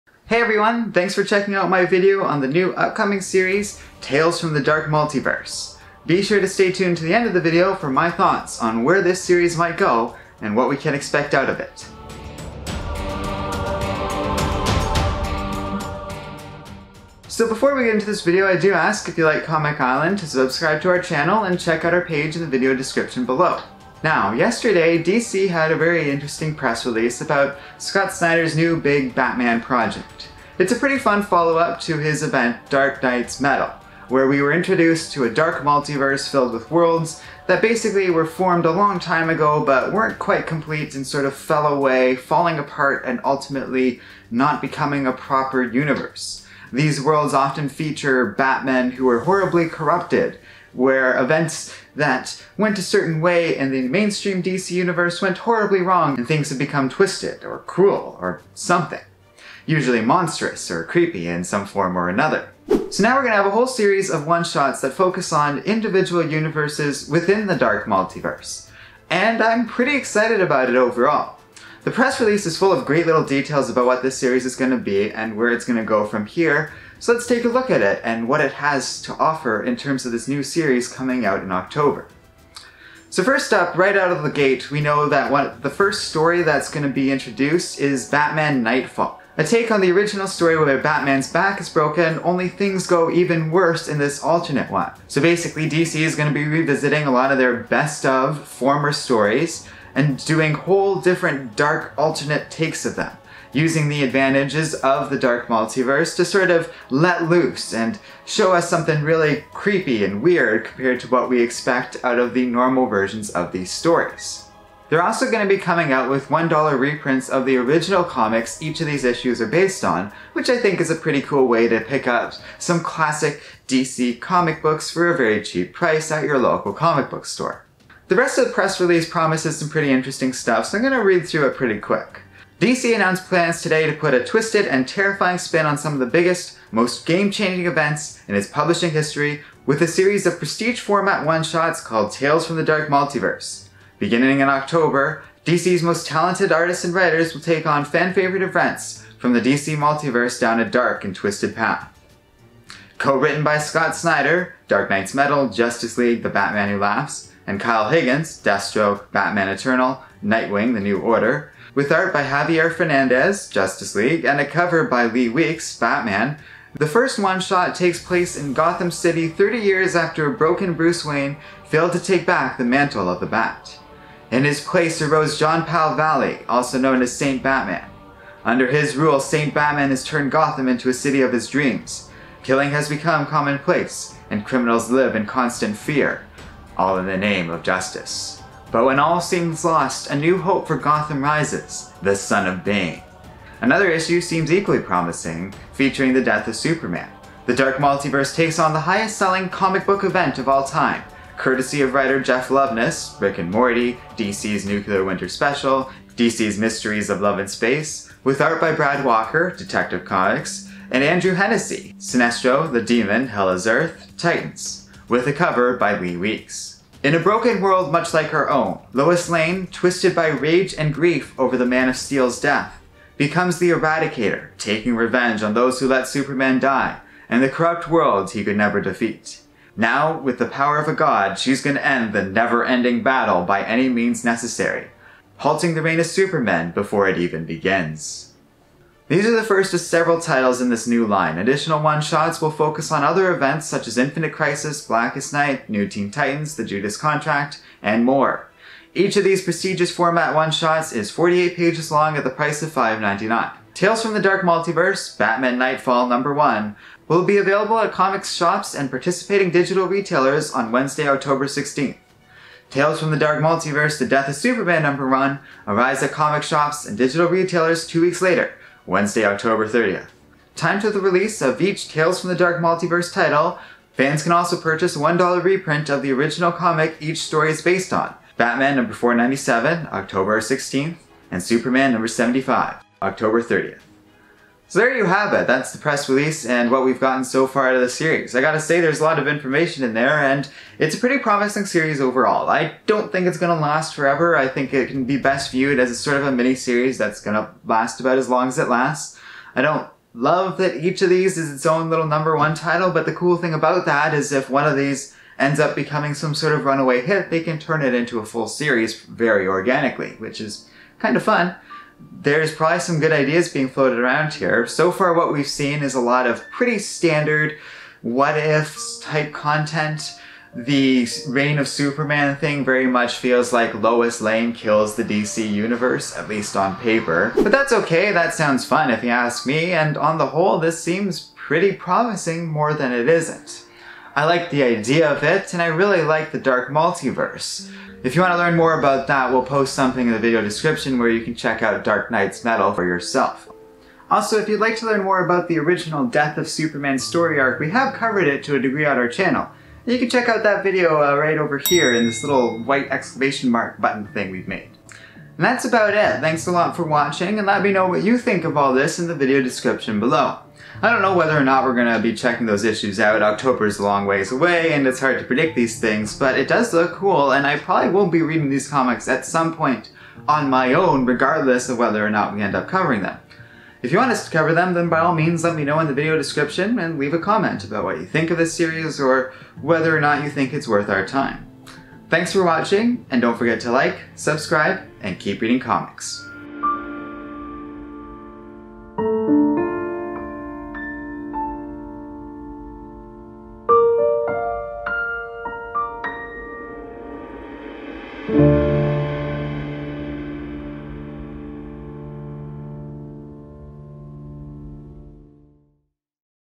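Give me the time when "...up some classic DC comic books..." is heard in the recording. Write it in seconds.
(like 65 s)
122 s.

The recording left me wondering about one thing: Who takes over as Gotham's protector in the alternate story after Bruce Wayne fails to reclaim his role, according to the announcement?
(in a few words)
Jean-Paul Valley.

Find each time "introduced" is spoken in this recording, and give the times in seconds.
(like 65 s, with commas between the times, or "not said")
34 s, 87 s.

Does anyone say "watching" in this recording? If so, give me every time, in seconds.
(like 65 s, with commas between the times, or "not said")
356 s, 382 s.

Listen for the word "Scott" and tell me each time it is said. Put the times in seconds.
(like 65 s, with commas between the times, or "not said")
27 s, 153 s.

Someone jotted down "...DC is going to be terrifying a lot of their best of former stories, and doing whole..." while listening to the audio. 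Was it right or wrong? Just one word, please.
wrong.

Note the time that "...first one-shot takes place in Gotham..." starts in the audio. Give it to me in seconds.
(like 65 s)
166 s.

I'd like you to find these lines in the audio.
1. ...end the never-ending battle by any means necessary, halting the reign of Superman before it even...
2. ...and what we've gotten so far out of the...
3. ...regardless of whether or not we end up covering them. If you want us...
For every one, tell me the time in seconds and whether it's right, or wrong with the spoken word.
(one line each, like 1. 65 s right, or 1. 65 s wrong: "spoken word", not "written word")
1. 231 s right
2. 286 s right
3. 371 s right.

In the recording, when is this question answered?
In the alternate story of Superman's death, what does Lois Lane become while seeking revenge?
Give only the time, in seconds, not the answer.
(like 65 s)
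223 s.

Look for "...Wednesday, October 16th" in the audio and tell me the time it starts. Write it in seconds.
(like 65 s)
260 s.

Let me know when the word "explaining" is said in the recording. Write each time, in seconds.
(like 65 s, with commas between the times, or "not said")
not said.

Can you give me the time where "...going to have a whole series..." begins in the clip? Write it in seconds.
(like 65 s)
63 s.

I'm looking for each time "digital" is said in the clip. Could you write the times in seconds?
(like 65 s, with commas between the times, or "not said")
259 s, 266 s.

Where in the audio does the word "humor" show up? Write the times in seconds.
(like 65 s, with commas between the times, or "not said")
not said.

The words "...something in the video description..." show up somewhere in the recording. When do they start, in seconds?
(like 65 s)
339 s.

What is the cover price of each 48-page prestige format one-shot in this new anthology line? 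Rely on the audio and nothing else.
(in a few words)
$5.99.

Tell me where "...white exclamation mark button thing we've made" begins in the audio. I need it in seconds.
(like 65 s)
352 s.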